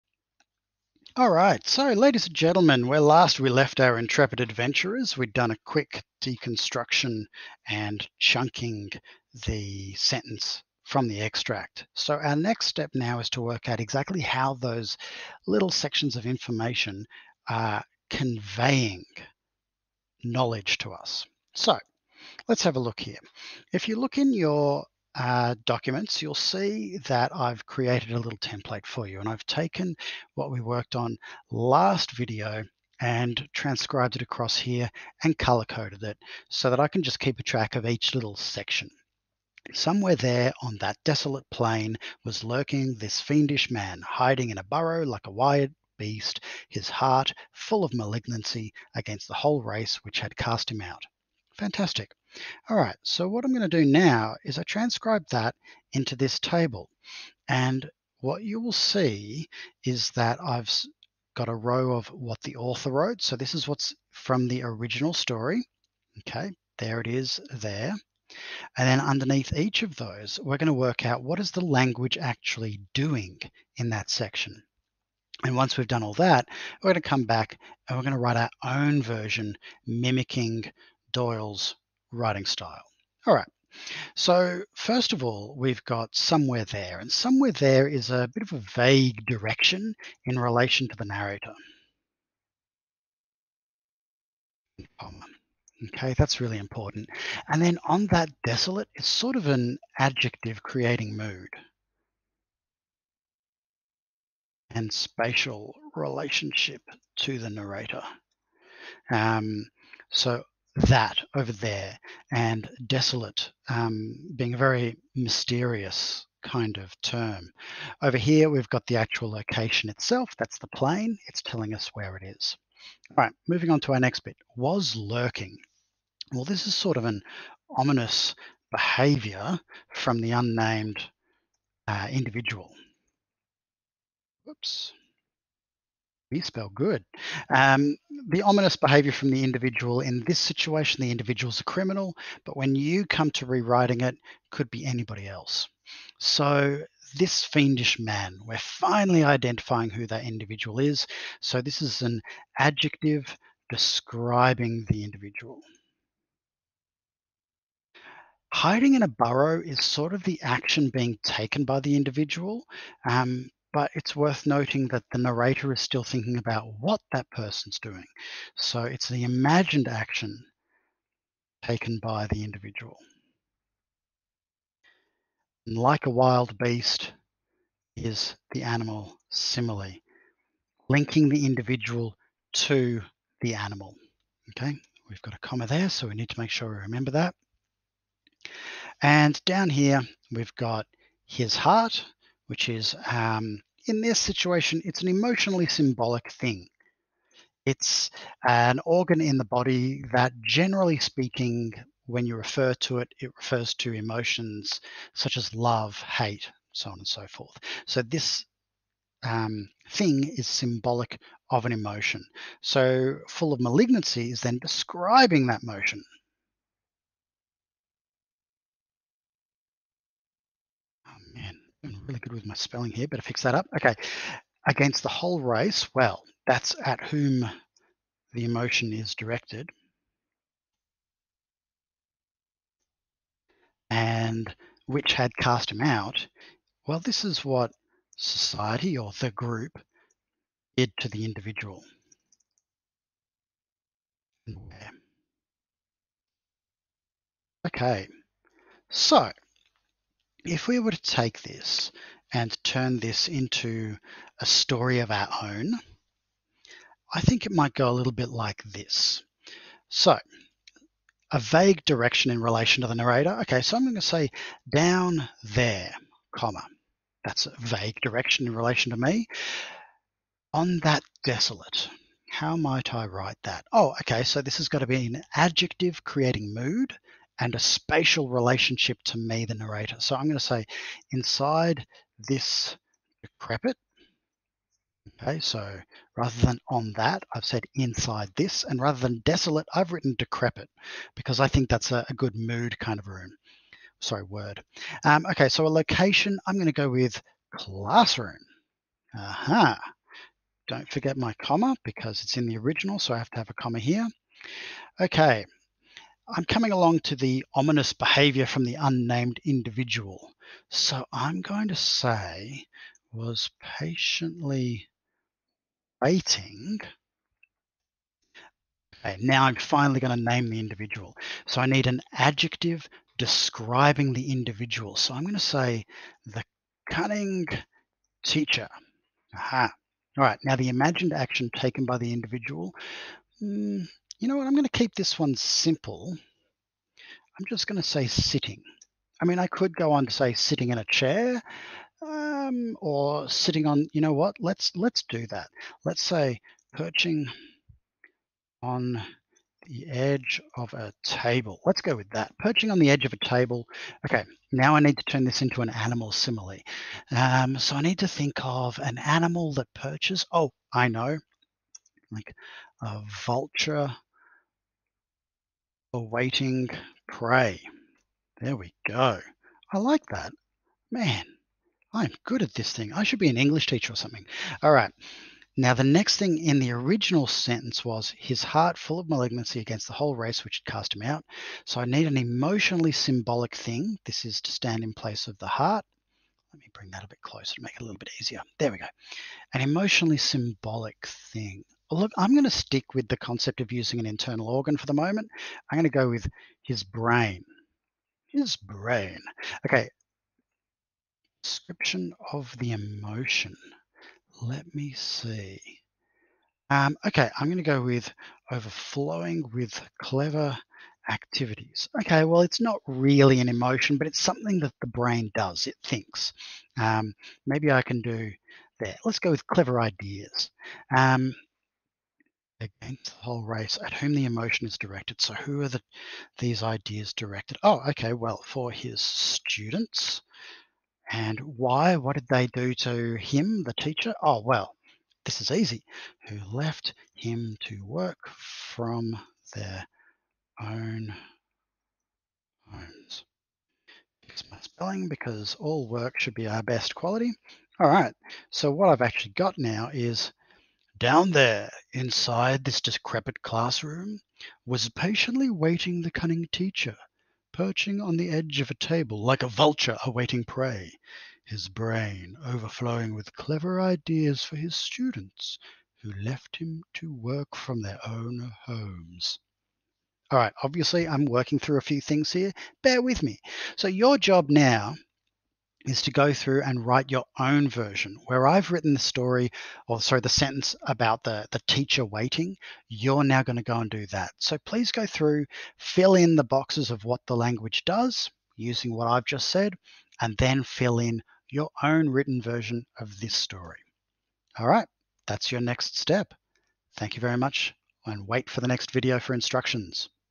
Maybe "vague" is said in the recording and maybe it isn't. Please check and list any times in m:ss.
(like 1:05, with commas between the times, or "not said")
1:28, 4:21, 4:27.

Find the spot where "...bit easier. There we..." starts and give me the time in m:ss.
6:27.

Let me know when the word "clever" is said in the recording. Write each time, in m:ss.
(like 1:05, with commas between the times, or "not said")
6:50, 6:59, 7:43.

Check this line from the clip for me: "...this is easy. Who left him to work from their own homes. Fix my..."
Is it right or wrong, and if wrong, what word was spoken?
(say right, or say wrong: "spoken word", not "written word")
right.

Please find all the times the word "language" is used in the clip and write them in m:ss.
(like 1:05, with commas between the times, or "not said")
1:11, 8:07.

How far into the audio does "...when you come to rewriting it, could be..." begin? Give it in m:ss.
2:22.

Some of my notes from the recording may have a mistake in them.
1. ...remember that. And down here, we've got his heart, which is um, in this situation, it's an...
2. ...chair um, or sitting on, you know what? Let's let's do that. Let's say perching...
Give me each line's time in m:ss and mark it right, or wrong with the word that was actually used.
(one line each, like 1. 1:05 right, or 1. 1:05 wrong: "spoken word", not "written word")
1. 3:06 right
2. 5:40 right.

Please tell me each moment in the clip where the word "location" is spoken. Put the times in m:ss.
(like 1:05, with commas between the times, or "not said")
1:59, 4:55.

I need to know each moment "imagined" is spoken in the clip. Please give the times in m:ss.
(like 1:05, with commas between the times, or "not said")
2:49, 5:30.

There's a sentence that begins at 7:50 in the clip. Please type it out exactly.
All right, obviously, I'm working through a few things here.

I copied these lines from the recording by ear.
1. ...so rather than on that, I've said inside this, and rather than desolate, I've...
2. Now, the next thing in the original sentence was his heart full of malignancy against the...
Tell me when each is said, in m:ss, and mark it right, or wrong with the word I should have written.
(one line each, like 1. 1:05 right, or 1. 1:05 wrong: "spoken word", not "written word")
1. 4:45 right
2. 6:15 right.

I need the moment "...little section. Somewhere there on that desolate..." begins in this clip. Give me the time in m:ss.
0:38.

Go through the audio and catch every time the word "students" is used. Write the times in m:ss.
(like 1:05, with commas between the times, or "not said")
7:09, 7:44.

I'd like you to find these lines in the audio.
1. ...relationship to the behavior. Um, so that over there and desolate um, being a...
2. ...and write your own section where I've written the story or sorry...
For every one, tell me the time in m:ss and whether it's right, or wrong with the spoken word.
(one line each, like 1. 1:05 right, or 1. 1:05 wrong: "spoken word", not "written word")
1. 1:45 wrong: "narrator", not "behavior"
2. 7:56 wrong: "version", not "section".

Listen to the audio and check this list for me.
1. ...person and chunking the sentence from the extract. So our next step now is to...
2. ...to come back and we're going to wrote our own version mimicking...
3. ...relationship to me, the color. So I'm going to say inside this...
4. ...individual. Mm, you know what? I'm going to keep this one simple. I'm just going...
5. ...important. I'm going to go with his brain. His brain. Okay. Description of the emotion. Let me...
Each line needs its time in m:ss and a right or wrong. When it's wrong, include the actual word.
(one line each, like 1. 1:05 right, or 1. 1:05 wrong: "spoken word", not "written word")
1. 0:06 wrong: "deconstruction", not "person"
2. 1:17 wrong: "write", not "wrote"
3. 4:38 wrong: "narrator", not "color"
4. 5:32 right
5. 6:34 wrong: "moment", not "important".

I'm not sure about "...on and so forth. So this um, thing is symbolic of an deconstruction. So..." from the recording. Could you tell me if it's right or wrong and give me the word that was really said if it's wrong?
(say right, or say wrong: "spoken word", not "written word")
wrong: "emotion", not "deconstruction".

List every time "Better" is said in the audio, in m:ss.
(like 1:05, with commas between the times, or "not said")
3:43.